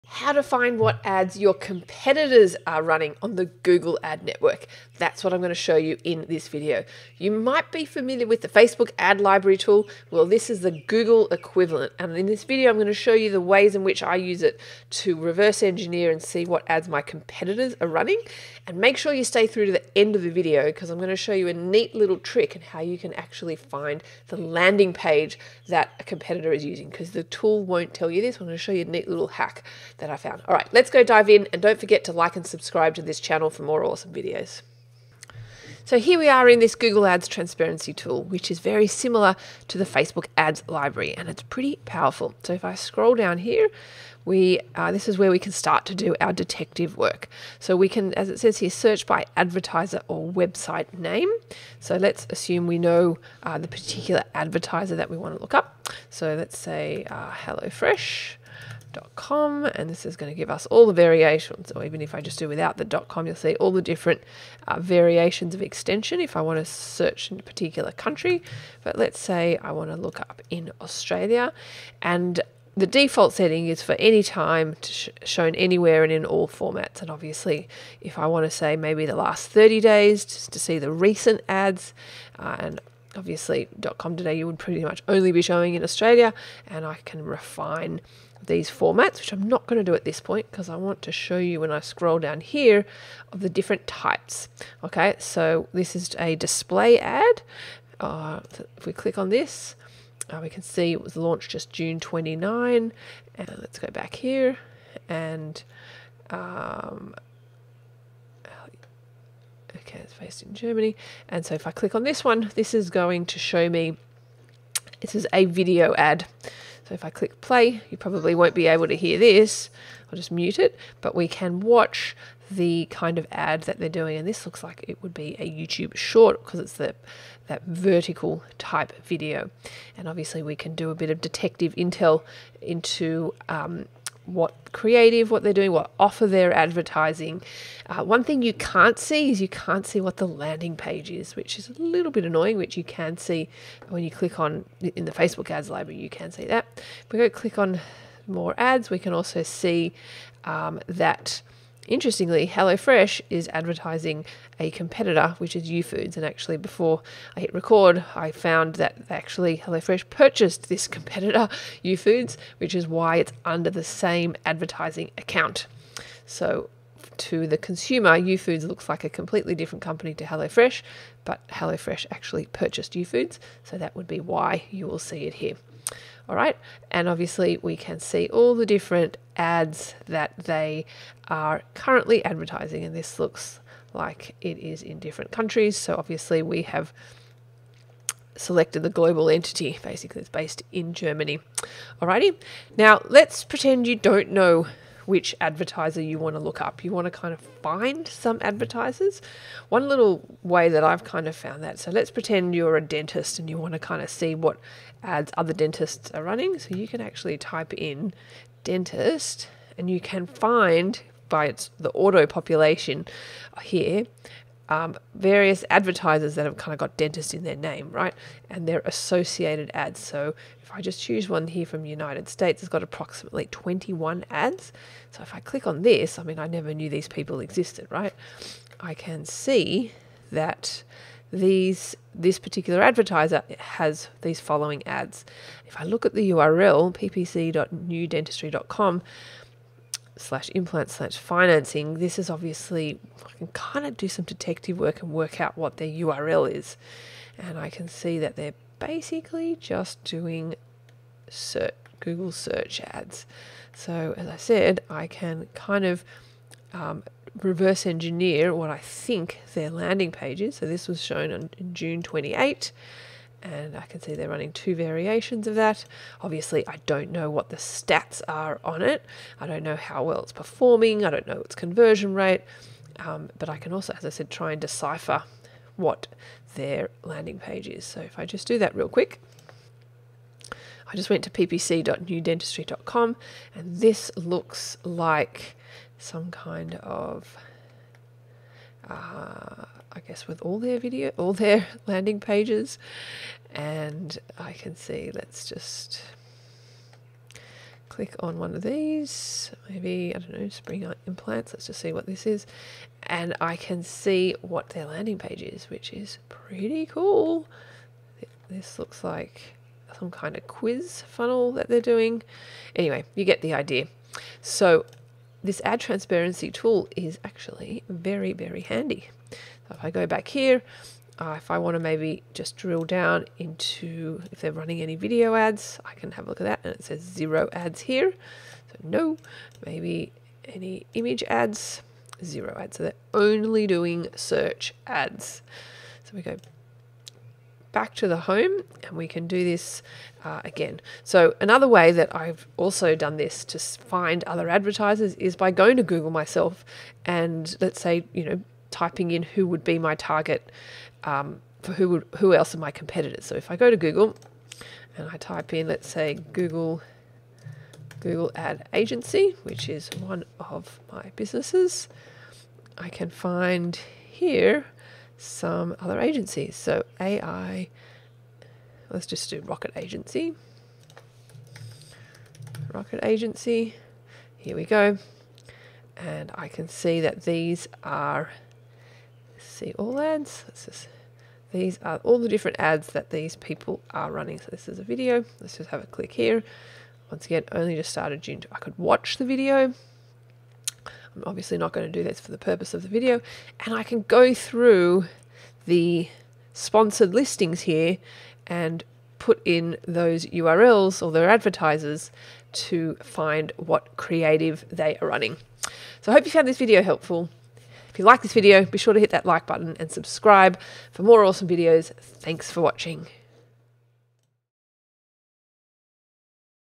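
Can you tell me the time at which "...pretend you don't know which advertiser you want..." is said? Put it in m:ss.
3:13.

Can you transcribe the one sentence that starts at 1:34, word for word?
Okay, so this is a display ad.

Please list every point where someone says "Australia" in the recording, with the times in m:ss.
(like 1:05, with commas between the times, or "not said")
1:10, 1:25.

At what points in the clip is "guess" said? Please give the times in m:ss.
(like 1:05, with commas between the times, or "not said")
4:49.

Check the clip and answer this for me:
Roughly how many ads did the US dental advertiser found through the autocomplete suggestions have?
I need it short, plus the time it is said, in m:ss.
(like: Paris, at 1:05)
21, at 3:43.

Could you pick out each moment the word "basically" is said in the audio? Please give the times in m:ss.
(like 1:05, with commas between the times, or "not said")
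3:09, 4:08.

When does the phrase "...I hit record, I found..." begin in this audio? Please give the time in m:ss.
2:37.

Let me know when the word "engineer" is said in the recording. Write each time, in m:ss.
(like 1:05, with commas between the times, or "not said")
0:15, 4:17.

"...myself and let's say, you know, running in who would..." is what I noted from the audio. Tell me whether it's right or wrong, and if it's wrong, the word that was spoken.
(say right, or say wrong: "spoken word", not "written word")
wrong: "typing", not "running".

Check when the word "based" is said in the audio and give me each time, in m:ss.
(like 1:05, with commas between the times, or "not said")
1:50, 3:10.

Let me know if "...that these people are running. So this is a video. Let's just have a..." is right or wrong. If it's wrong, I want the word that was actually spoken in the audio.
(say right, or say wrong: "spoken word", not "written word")
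right.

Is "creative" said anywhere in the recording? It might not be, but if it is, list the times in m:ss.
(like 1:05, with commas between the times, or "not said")
2:14, 6:43.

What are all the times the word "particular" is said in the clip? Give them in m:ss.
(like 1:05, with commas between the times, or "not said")
0:53, 1:07, 3:52.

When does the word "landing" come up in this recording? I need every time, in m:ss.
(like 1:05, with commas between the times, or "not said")
0:24, 2:20, 4:19, 4:37, 4:51, 5:04.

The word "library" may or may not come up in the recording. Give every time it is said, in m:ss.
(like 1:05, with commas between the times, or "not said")
0:09, 0:40, 2:25.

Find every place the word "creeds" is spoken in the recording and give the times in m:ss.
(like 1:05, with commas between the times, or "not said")
not said.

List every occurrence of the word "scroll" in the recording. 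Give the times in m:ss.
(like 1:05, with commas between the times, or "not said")
0:42, 1:31.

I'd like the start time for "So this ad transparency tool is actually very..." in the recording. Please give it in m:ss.
5:14.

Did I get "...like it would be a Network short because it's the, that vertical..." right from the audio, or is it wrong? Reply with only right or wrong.
wrong.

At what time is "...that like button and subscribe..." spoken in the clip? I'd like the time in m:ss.
6:49.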